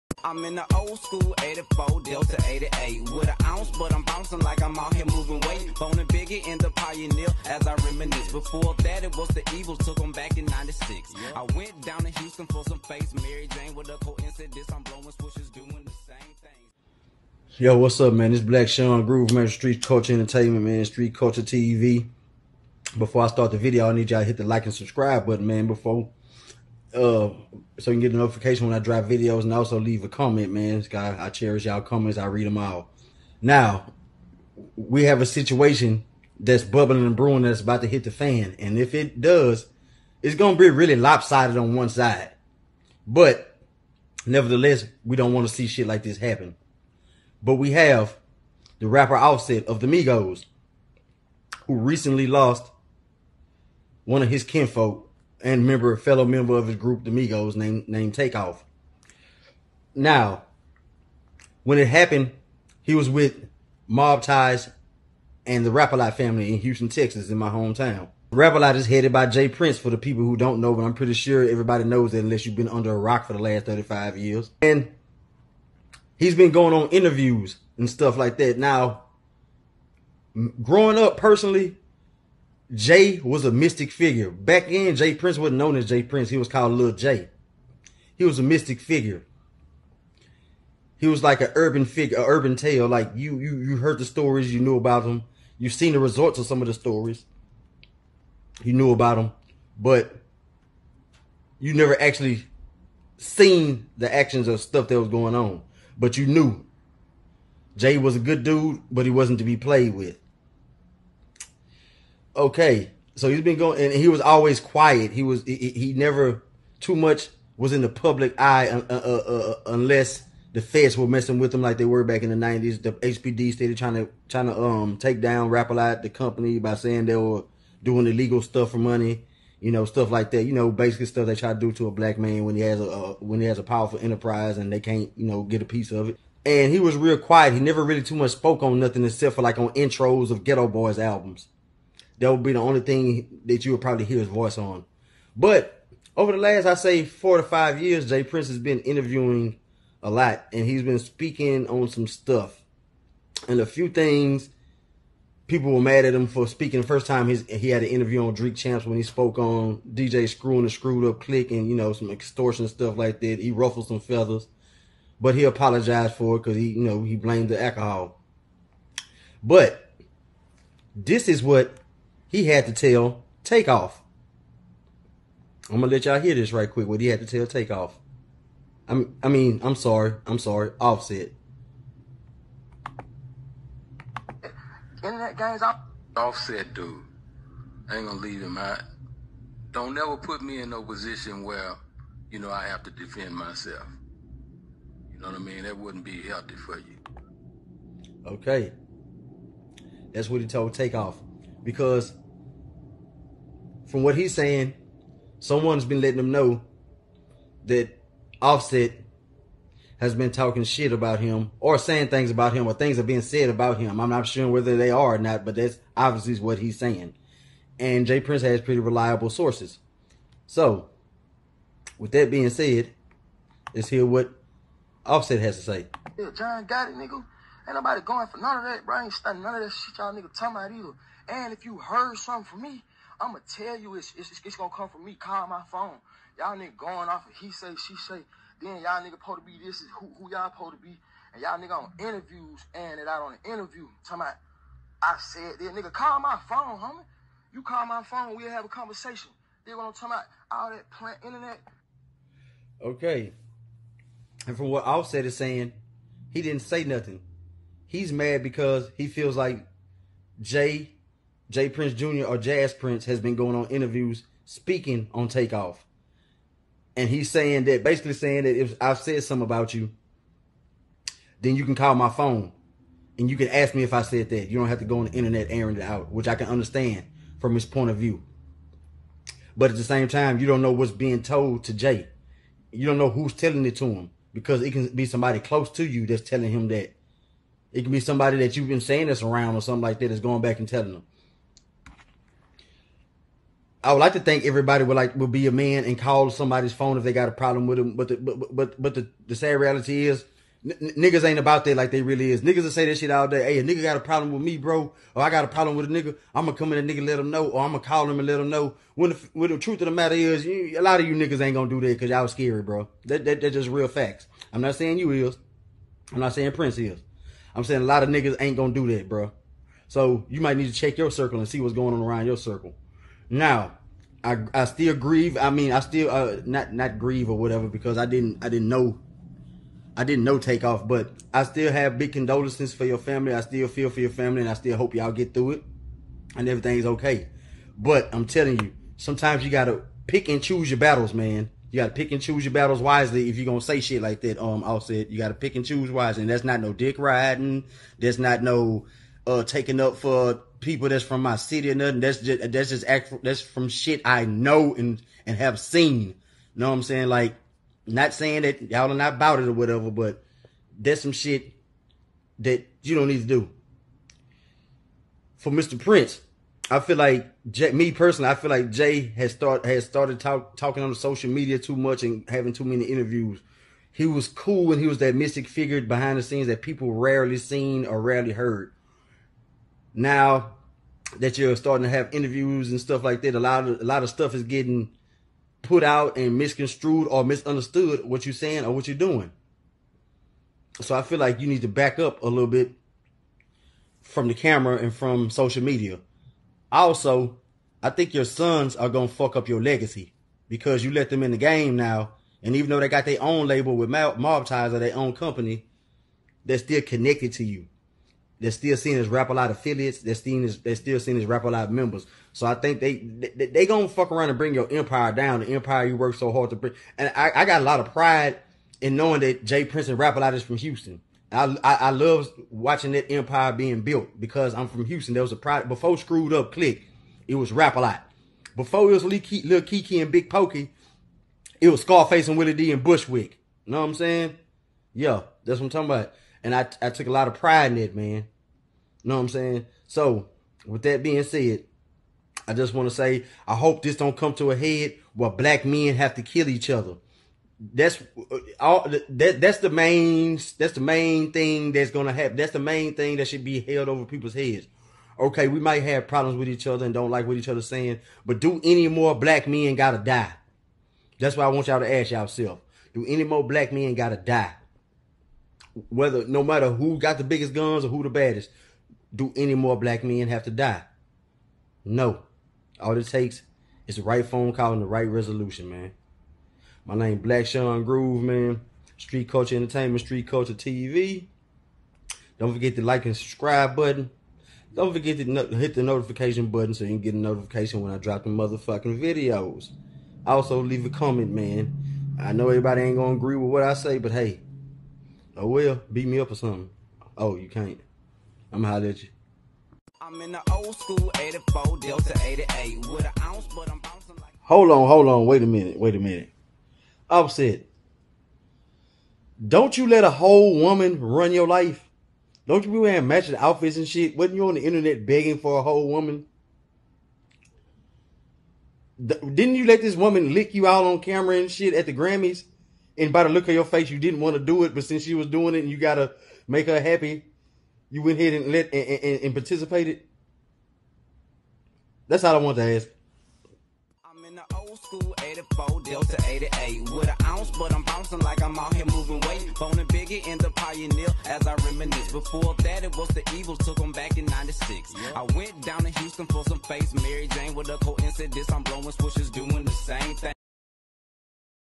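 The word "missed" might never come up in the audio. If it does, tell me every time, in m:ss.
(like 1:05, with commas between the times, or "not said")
not said.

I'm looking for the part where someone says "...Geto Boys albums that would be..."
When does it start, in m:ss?
2:20.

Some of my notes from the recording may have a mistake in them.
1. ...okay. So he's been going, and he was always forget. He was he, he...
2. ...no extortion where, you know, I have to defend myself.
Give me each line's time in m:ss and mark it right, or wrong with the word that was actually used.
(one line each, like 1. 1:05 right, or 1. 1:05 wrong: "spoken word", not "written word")
1. 1:52 wrong: "quiet", not "forget"
2. 3:10 wrong: "position", not "extortion".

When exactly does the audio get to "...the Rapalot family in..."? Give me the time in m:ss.
1:05.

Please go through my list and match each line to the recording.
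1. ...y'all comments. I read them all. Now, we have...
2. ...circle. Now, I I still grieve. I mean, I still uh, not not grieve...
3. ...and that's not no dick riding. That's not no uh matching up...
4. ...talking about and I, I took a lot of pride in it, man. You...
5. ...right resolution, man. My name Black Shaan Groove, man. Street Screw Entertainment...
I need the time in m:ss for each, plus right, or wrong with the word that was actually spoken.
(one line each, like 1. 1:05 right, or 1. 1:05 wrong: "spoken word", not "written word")
1. 0:31 right
2. 5:22 right
3. 5:46 wrong: "taking", not "matching"
4. 7:15 right
5. 7:54 wrong: "Kulture", not "Screw".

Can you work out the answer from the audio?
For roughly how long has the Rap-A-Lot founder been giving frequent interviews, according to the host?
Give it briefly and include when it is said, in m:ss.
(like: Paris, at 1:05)
4 to 5 years, at 2:27.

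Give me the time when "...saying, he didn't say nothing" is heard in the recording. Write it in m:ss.
4:15.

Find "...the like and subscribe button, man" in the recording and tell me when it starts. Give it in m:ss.
0:24.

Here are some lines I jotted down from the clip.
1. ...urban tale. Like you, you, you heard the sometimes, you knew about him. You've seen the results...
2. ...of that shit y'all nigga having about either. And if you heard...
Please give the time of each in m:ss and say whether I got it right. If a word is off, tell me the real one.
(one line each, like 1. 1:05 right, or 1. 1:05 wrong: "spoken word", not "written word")
1. 1:32 wrong: "stories", not "sometimes"
2. 3:49 wrong: "talking", not "having".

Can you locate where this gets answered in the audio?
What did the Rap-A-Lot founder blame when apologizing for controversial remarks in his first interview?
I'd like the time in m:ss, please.
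2:47.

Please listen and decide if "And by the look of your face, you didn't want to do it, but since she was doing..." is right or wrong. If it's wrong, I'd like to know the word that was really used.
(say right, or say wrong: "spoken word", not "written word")
right.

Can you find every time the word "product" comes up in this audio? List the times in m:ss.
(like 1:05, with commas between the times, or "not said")
7:05.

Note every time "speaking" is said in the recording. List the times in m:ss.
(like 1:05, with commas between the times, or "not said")
2:30, 2:36, 4:24.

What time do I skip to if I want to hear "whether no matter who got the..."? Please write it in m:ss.
7:45.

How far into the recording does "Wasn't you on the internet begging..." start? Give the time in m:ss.
8:34.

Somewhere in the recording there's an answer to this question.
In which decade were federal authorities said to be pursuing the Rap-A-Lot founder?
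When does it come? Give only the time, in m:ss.
2:02.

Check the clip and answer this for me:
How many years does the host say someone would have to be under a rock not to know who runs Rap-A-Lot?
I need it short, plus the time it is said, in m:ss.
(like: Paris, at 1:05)
35, at 1:13.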